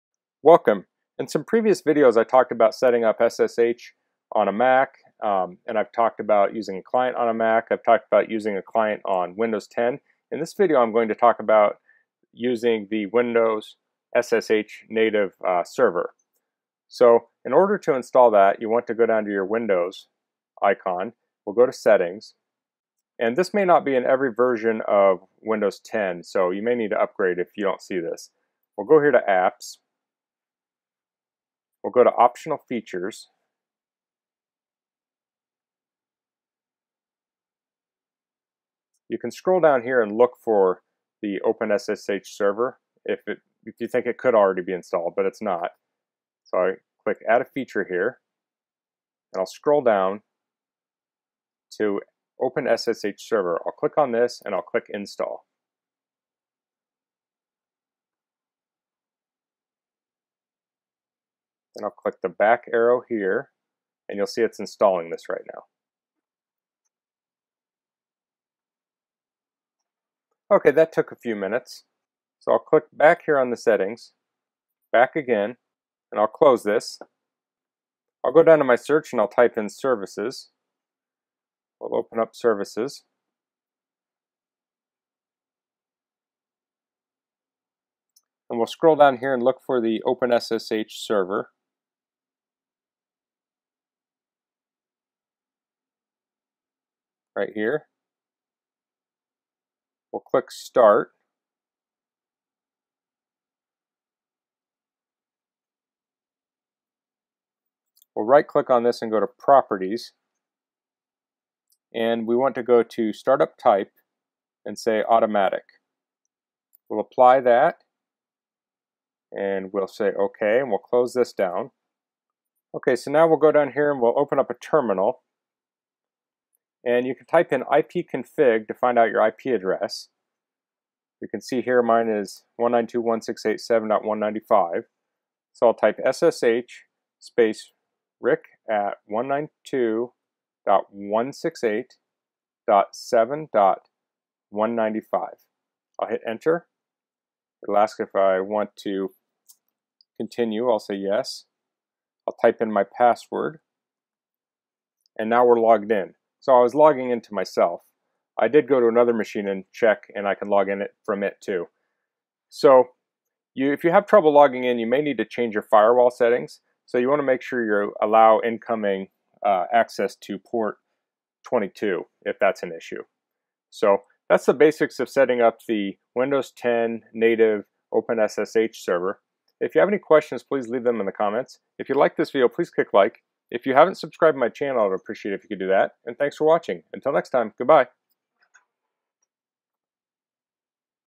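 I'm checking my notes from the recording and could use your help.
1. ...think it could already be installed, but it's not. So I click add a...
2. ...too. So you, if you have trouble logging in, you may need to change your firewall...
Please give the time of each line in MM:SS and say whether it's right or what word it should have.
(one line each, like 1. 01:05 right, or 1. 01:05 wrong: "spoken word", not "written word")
1. 00:43 right
2. 02:41 right.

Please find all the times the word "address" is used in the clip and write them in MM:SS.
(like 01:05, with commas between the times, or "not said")
02:09.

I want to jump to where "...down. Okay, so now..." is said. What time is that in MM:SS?
02:01.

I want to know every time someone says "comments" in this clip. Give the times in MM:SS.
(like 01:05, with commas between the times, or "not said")
03:01.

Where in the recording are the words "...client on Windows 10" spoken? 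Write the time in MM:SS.
00:08.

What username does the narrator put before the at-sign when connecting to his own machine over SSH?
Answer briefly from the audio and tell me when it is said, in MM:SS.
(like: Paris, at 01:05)
rick, at 02:18.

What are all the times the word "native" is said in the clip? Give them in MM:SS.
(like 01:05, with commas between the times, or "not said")
00:14, 02:57.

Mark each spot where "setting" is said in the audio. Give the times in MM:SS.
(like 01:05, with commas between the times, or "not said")
00:02, 00:21, 01:13, 02:46, 02:55.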